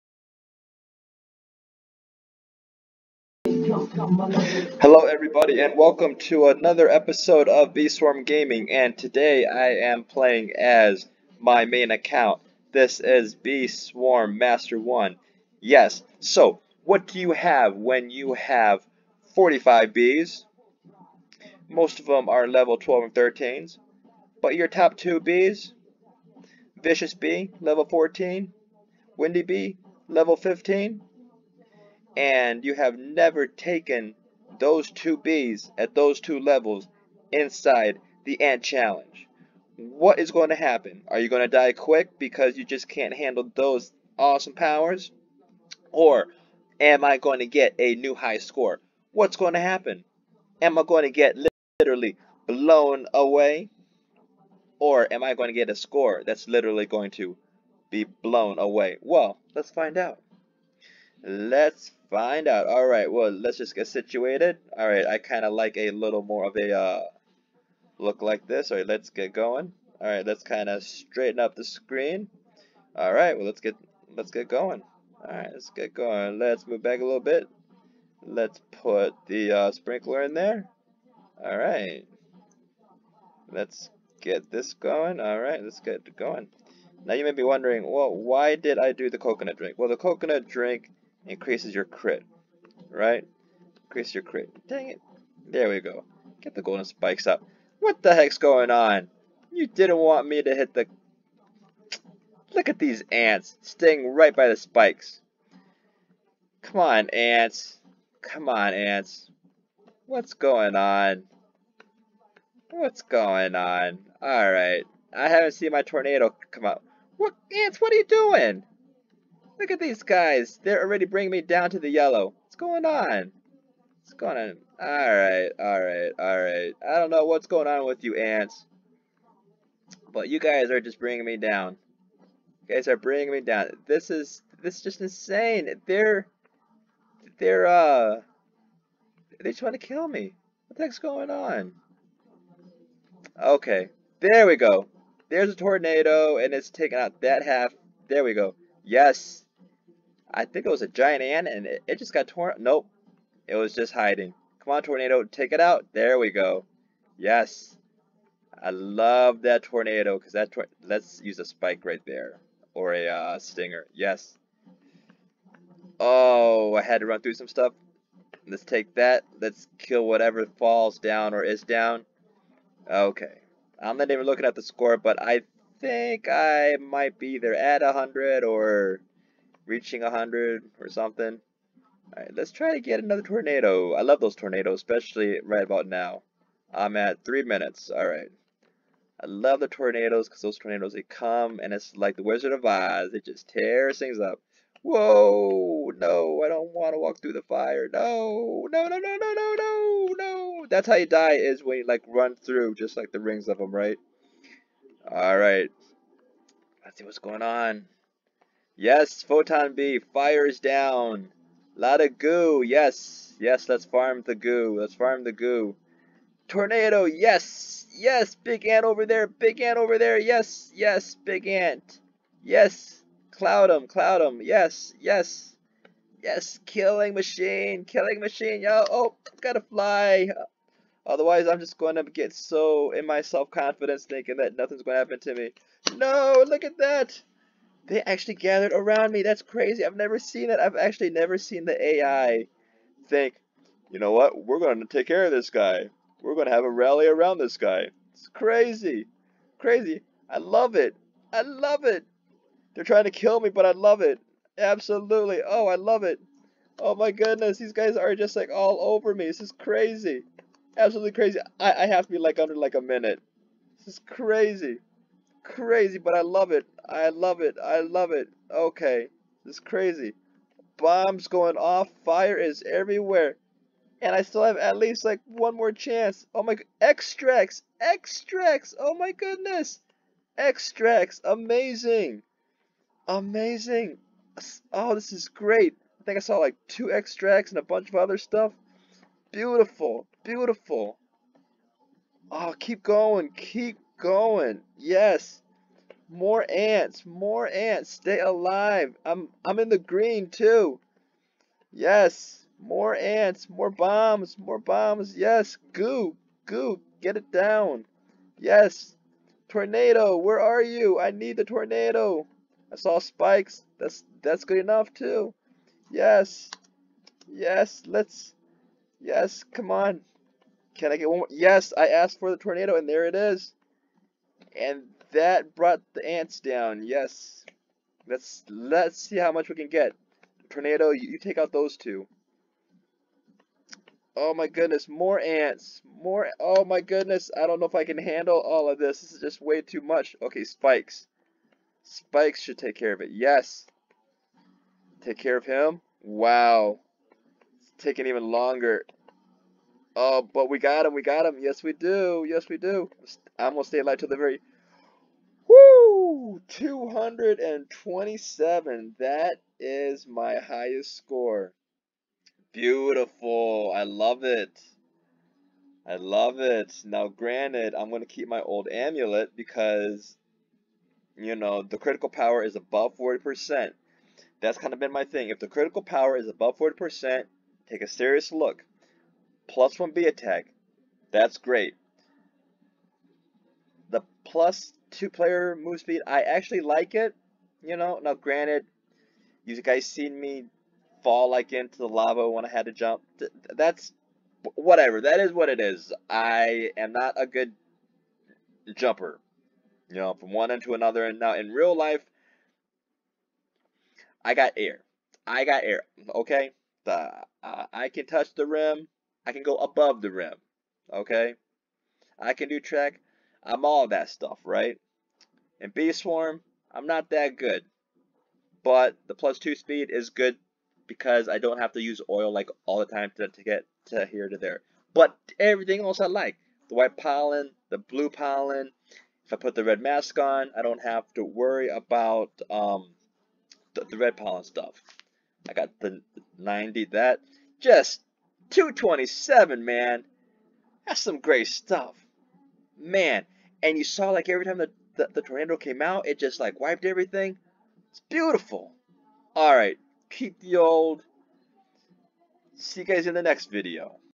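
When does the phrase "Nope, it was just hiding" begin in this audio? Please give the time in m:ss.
2:32.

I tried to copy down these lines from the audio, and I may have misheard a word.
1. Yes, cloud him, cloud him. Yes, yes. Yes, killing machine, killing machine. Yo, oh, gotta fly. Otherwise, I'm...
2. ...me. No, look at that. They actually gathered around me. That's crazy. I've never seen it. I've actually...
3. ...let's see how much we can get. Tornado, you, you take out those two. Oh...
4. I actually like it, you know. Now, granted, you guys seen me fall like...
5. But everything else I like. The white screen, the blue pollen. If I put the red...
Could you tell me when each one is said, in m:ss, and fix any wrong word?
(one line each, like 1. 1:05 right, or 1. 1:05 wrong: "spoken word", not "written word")
1. 3:42 right
2. 3:55 right
3. 5:28 right
4. 6:26 right
5. 7:04 wrong: "pollen", not "screen".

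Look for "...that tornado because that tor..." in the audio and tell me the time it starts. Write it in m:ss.
2:39.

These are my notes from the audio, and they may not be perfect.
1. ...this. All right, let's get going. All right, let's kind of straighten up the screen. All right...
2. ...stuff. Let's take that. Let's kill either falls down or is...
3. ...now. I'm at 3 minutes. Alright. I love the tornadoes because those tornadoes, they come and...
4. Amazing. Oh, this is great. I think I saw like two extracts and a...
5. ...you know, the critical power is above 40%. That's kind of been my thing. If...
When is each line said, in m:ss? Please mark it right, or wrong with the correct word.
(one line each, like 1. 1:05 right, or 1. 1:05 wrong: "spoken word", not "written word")
1. 1:08 right
2. 2:47 wrong: "whatever", not "either"
3. 3:05 right
4. 4:43 right
5. 6:11 right.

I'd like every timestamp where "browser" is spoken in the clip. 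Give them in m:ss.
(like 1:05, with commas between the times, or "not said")
not said.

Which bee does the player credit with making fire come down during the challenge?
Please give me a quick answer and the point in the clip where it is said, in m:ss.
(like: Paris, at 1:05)
Photon Bee, at 3:29.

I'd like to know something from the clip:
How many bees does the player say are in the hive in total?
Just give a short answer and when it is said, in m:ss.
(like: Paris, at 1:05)
45, at 0:19.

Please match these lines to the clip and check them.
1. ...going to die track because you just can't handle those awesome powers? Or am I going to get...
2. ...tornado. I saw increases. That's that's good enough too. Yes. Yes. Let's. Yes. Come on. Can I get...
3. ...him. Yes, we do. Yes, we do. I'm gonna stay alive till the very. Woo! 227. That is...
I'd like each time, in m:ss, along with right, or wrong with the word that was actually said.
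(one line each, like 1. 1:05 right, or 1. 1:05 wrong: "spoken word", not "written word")
1. 0:41 wrong: "quick", not "track"
2. 5:11 wrong: "spikes", not "increases"
3. 5:51 right.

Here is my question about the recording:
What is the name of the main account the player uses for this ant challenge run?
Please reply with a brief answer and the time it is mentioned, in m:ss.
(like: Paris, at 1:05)
Swarm Master 1, at 0:13.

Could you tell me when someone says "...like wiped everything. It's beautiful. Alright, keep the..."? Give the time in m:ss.
7:26.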